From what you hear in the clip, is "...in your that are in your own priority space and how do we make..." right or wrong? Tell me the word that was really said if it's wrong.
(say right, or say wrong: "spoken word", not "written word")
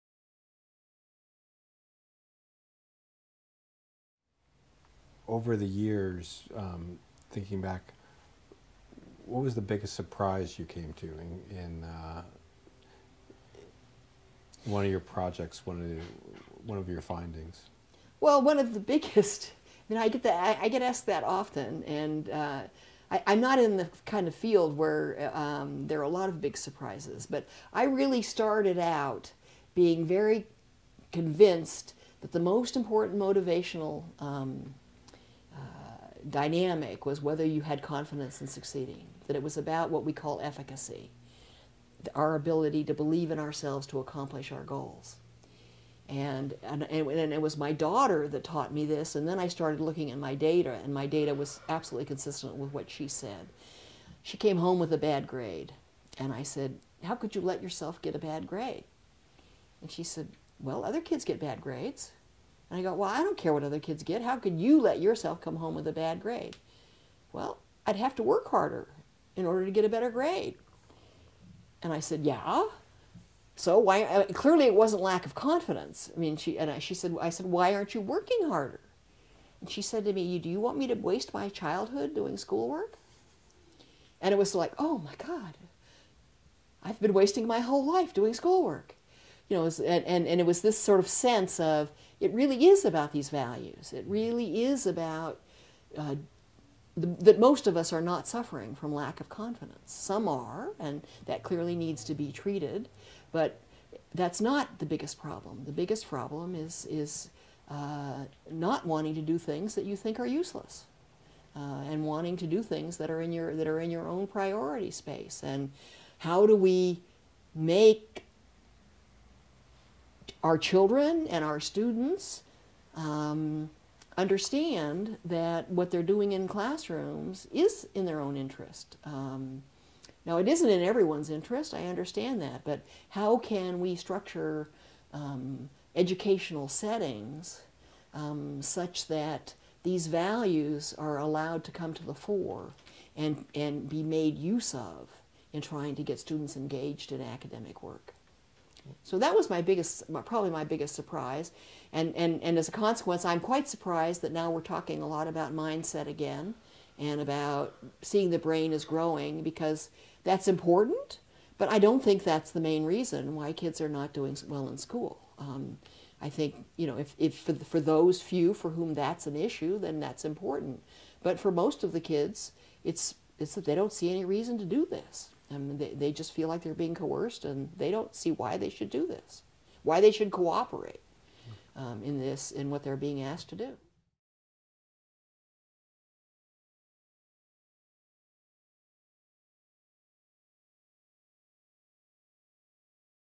right.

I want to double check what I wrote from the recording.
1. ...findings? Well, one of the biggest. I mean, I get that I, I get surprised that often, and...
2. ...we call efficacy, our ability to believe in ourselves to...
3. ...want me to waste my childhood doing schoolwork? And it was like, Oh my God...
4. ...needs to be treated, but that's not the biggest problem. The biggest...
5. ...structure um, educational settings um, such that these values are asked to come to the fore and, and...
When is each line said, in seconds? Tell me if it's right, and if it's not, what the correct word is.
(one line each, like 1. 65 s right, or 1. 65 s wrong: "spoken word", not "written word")
1. 17 s wrong: "asked", not "surprised"
2. 40 s right
3. 80 s right
4. 101 s right
5. 133 s wrong: "allowed", not "asked".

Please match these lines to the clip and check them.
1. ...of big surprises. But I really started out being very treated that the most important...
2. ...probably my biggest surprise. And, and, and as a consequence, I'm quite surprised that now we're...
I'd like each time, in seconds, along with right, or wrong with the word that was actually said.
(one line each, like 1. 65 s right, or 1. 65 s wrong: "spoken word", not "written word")
1. 26 s wrong: "convinced", not "treated"
2. 150 s right.